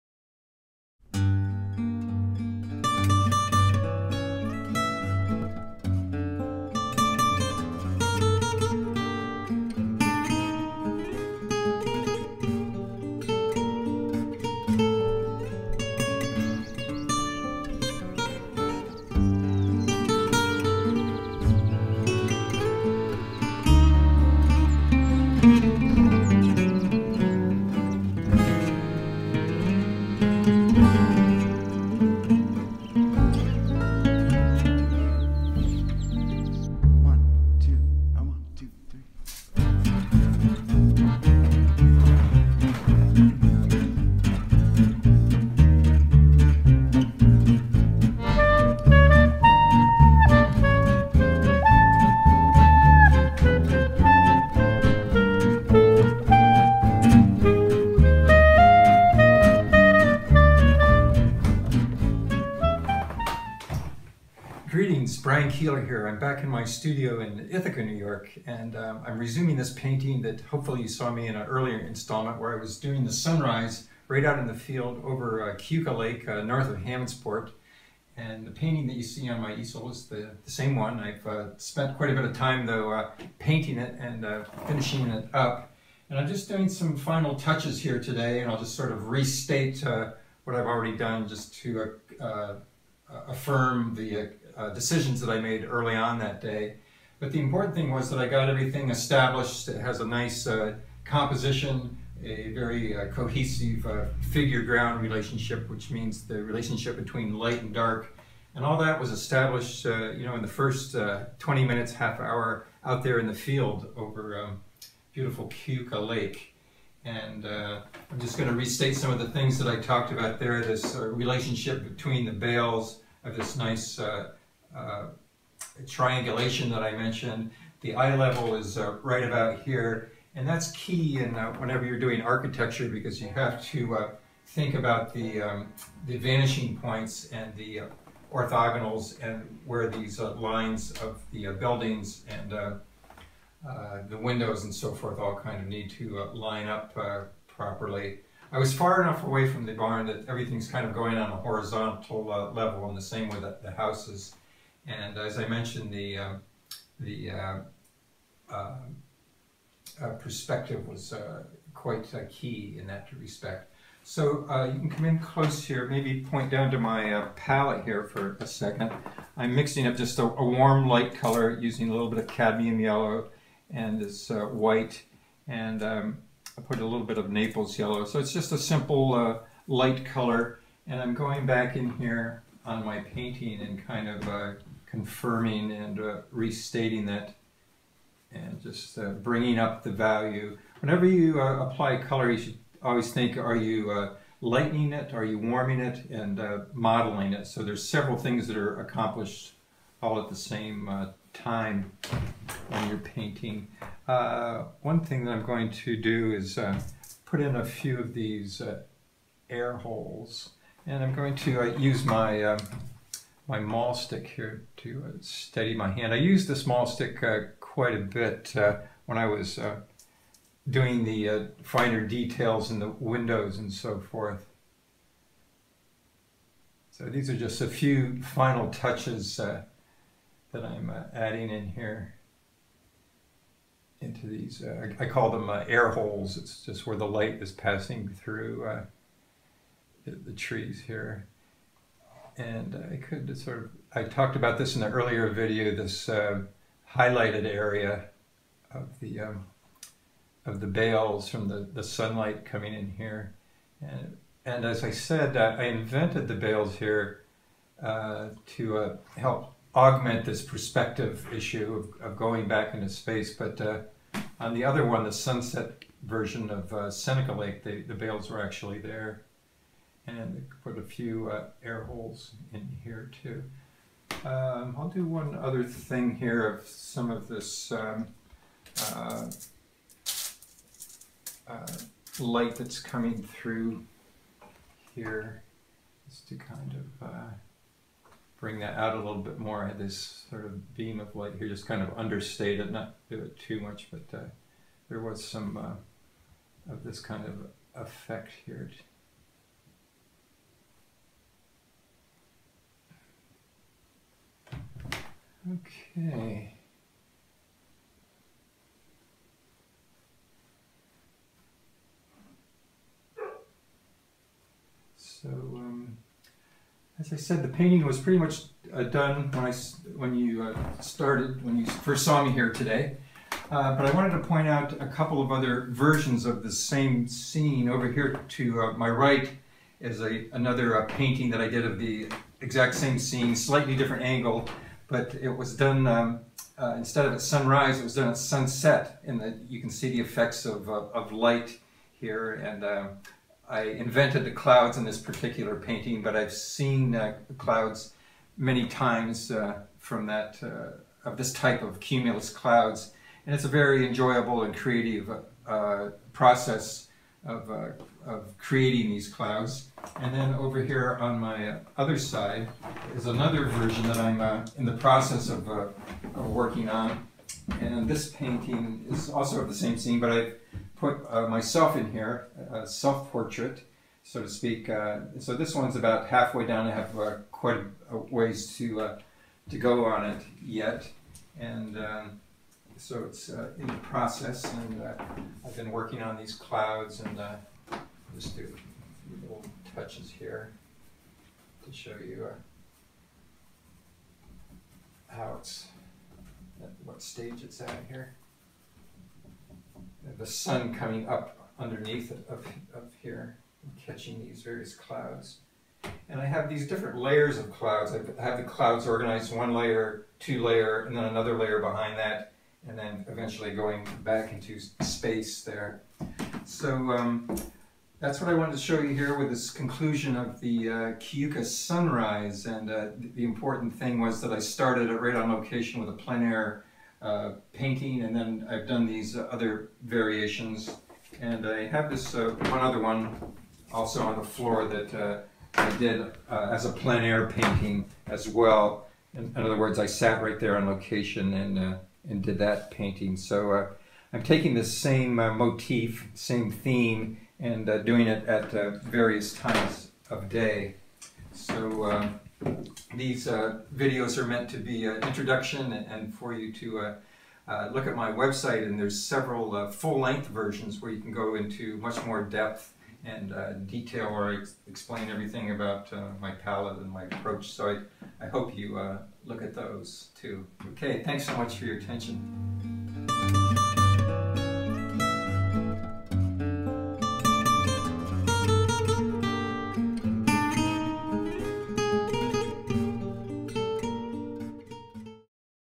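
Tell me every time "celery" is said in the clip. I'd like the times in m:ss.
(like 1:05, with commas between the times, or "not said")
not said.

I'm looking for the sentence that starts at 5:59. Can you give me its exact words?
And then over here on my other side is another version that I'm uh, in the process of, uh, of, working on.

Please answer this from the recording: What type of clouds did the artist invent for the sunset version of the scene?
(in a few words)
cumulus.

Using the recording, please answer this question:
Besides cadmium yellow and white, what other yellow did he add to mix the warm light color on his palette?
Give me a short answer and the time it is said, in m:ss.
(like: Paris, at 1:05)
Naples yellow, at 2:57.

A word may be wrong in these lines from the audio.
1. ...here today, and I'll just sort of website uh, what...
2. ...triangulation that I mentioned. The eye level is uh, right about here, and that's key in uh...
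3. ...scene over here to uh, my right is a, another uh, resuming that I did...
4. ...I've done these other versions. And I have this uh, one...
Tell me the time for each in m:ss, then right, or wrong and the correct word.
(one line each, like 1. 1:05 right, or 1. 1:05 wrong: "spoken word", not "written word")
1. 1:27 wrong: "restate", not "website"
2. 2:05 right
3. 5:27 wrong: "painting", not "resuming"
4. 7:08 wrong: "variations", not "versions".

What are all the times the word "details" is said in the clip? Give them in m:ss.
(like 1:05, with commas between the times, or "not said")
3:42, 7:43.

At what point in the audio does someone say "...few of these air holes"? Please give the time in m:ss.
3:27.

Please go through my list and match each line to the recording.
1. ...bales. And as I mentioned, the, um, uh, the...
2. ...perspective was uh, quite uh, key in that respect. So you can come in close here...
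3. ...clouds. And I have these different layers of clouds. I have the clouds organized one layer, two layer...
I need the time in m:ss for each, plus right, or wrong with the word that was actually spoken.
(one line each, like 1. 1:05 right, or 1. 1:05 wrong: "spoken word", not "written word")
1. 2:33 wrong: "houses", not "bales"
2. 2:40 right
3. 6:44 right.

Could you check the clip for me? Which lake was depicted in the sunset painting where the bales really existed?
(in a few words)
Seneca Lake.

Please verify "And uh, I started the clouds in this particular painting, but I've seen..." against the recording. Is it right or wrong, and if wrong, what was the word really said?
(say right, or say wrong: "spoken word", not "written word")
wrong: "invented", not "started".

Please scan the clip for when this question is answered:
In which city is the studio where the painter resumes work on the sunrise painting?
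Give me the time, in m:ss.
1:07.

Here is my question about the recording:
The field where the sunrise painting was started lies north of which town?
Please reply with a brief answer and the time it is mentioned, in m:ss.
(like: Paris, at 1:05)
Hammondsport, at 1:16.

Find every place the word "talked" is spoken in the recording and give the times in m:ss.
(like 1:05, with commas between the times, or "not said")
1:59, 4:04.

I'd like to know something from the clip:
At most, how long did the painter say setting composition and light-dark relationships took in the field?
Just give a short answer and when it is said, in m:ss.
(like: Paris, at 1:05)
half hour, at 1:51.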